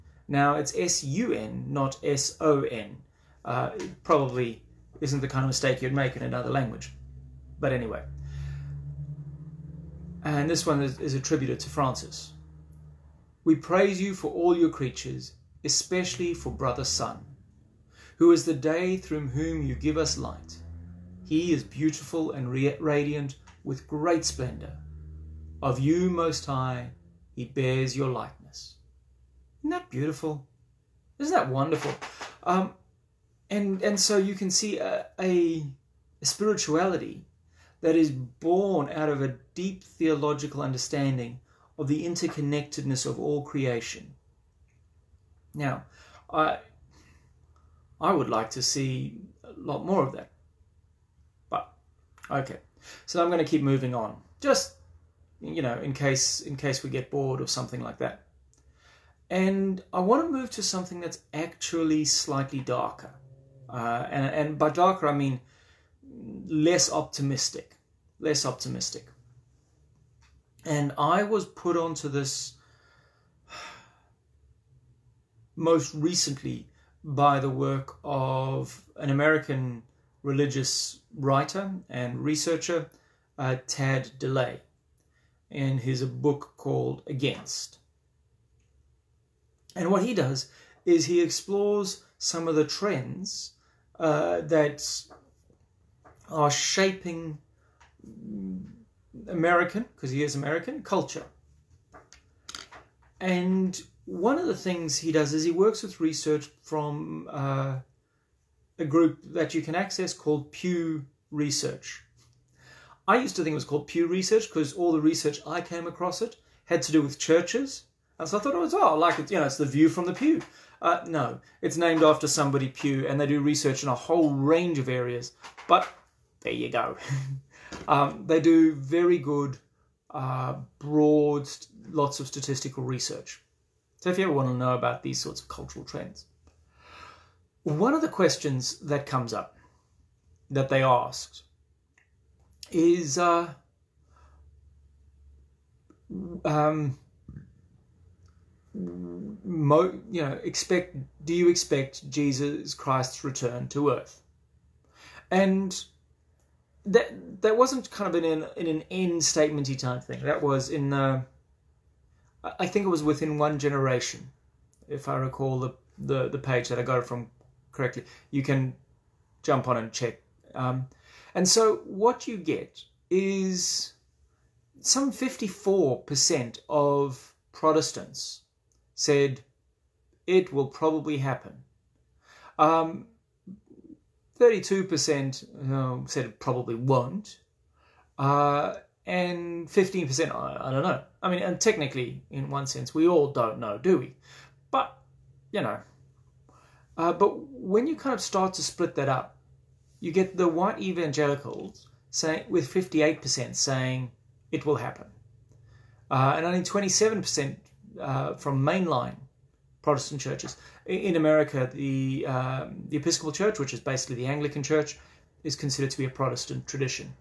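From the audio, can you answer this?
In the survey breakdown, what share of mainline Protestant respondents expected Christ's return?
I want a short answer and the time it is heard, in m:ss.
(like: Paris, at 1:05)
27%, at 3:26.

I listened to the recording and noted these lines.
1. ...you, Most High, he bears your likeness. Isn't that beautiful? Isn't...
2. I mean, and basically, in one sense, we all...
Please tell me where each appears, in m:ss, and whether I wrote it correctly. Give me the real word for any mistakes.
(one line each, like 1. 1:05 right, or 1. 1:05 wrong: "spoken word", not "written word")
1. 0:25 right
2. 3:11 wrong: "technically", not "basically".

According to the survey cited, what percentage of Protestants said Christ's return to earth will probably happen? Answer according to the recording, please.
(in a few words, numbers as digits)
54%.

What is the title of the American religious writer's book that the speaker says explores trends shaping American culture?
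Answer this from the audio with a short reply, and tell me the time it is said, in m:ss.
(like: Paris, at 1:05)
Against, at 1:27.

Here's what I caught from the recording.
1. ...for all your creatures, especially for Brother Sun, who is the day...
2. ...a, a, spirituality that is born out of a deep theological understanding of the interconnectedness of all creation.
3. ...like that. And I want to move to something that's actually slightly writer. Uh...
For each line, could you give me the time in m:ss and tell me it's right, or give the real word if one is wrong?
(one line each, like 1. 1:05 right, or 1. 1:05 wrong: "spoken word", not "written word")
1. 0:14 right
2. 0:34 right
3. 0:57 wrong: "darker", not "writer".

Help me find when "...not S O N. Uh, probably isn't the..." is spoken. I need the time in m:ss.
0:01.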